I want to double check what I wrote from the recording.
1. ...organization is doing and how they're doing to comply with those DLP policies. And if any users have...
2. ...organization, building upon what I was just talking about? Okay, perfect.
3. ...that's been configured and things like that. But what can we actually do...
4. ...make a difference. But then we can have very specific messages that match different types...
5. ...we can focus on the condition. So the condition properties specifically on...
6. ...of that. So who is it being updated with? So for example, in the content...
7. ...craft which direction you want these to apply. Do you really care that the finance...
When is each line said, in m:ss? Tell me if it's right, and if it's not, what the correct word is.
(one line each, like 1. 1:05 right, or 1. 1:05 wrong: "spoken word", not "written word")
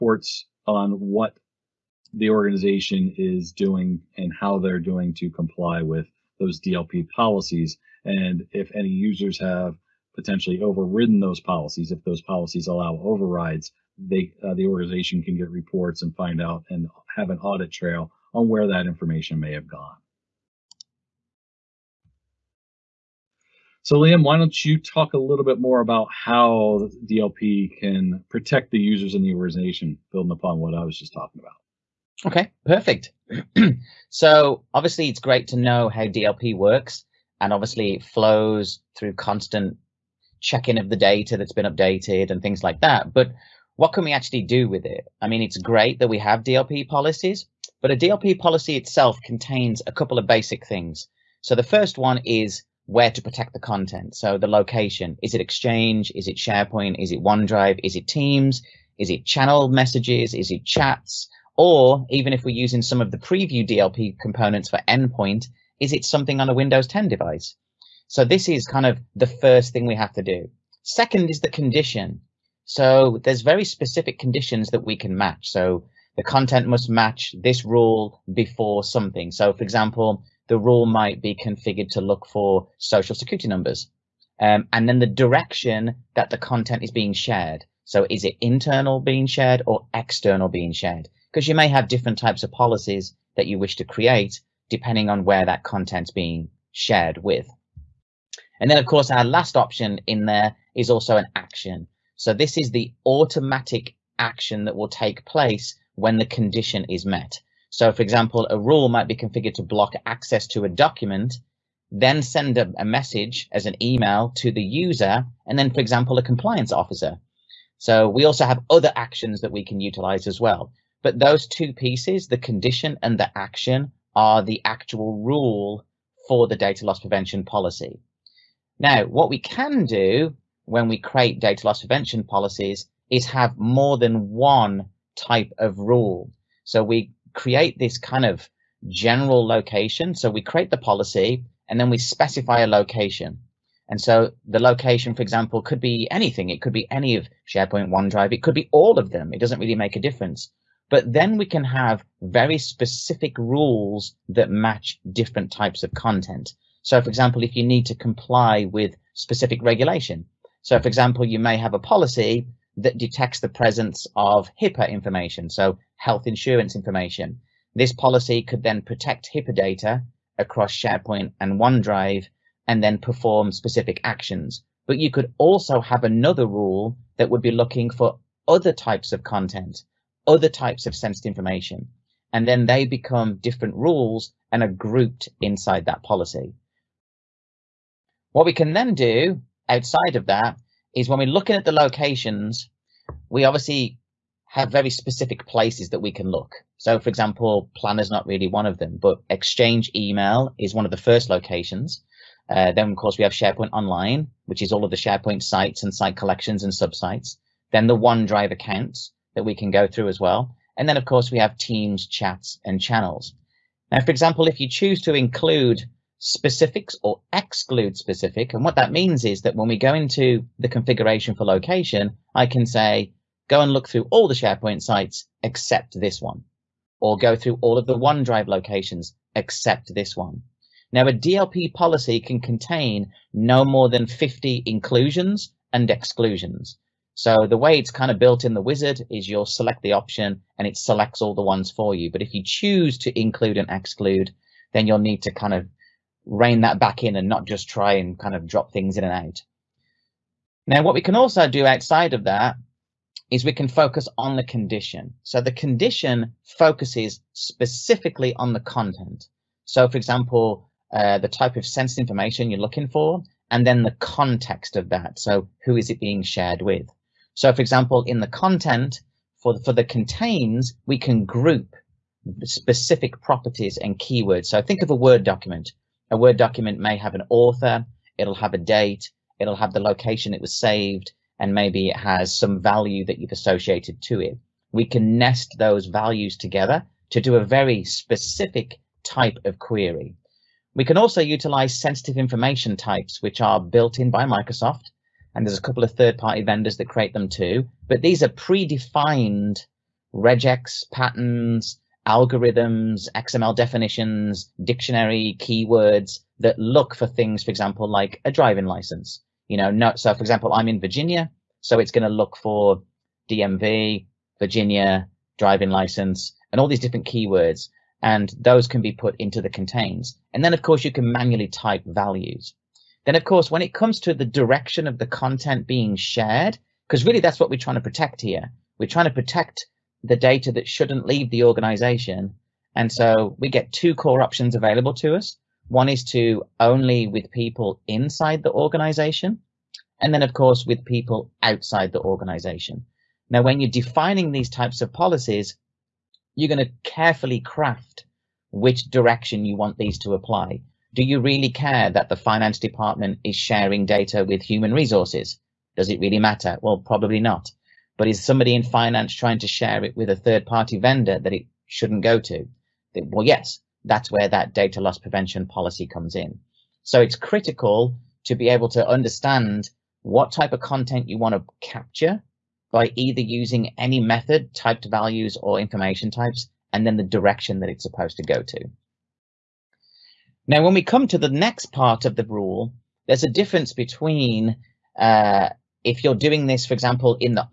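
1. 0:02 right
2. 0:29 right
3. 0:41 wrong: "updated", not "configured"
4. 2:29 wrong: "rules", not "messages"
5. 4:13 wrong: "focuses", not "properties"
6. 4:24 wrong: "shared", not "updated"
7. 5:47 right.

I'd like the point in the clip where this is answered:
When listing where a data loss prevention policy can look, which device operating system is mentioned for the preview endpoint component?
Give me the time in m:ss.
1:06.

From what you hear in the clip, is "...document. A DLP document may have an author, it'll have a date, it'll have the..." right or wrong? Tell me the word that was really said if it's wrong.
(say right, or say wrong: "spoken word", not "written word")
wrong: "Word", not "DLP".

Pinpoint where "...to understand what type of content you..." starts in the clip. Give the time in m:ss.
6:08.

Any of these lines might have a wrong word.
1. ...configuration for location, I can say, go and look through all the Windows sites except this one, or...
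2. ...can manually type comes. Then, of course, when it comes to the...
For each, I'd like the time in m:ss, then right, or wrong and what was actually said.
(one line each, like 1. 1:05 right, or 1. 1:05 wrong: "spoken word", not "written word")
1. 3:40 wrong: "SharePoint", not "Windows"
2. 5:20 wrong: "values", not "comes".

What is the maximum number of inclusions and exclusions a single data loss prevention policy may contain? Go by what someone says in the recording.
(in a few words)
50.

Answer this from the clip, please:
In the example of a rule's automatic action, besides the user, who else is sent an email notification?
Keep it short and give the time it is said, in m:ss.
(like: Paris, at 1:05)
a compliance officer, at 1:56.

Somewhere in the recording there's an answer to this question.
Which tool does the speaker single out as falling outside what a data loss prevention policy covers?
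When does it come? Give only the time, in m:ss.
3:17.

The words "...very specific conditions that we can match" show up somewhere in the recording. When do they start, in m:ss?
1:13.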